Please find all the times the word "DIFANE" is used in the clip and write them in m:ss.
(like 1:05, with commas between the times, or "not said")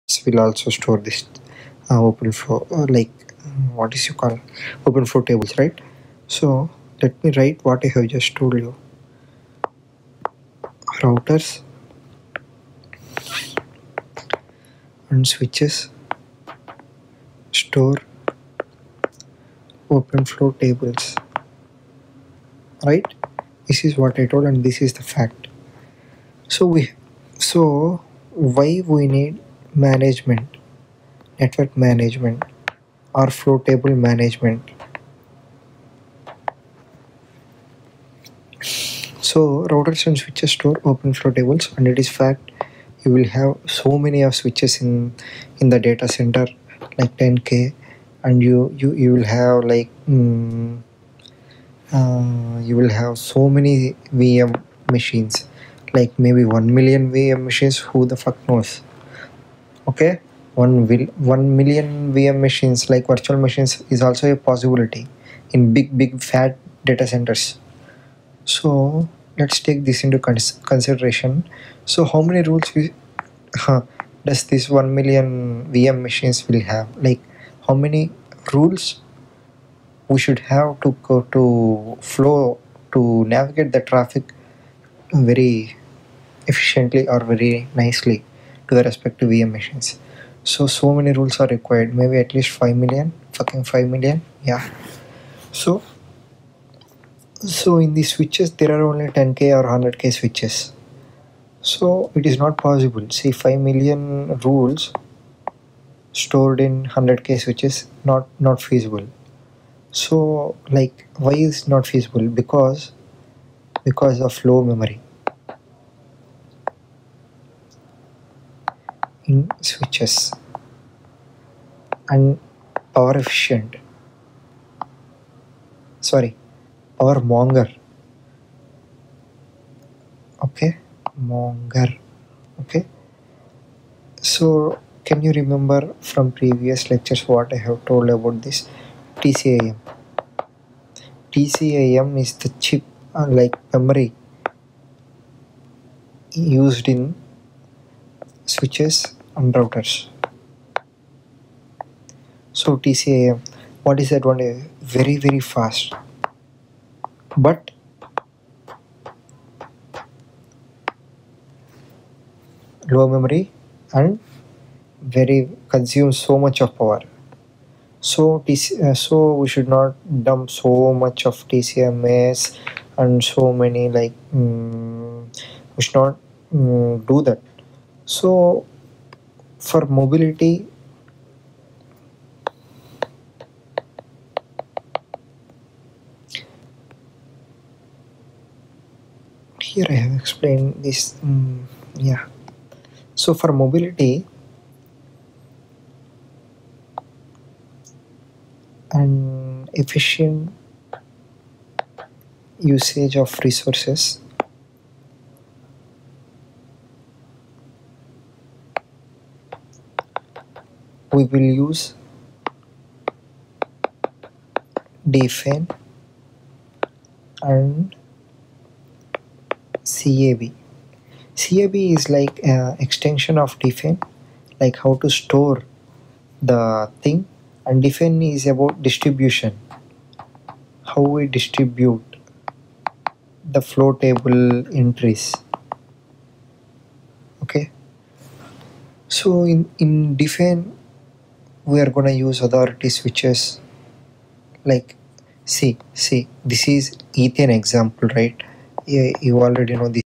3:35, 3:43, 3:47, 4:00.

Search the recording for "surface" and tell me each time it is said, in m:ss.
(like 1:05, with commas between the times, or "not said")
not said.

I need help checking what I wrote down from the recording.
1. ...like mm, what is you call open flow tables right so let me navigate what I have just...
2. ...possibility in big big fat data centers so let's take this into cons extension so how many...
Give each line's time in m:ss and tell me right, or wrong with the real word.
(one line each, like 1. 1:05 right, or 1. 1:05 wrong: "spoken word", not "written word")
1. 0:02 wrong: "write", not "navigate"
2. 1:04 wrong: "consideration", not "extension".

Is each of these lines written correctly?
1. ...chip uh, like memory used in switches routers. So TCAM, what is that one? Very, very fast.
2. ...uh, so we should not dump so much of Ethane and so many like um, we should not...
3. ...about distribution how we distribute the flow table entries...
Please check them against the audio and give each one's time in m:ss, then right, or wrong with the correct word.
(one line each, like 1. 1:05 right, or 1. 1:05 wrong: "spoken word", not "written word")
1. 2:22 right
2. 2:48 wrong: "TCAMs", not "Ethane"
3. 3:48 right.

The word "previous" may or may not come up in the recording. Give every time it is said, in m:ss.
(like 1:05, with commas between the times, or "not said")
2:16.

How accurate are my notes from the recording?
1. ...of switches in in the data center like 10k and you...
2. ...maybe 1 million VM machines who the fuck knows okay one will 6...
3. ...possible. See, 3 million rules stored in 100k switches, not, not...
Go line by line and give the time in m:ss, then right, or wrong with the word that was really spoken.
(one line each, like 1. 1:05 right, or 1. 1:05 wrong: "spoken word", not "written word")
1. 0:44 right
2. 0:56 wrong: "1", not "6"
3. 1:42 wrong: "5", not "3".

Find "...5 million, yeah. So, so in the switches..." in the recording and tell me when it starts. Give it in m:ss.
1:33.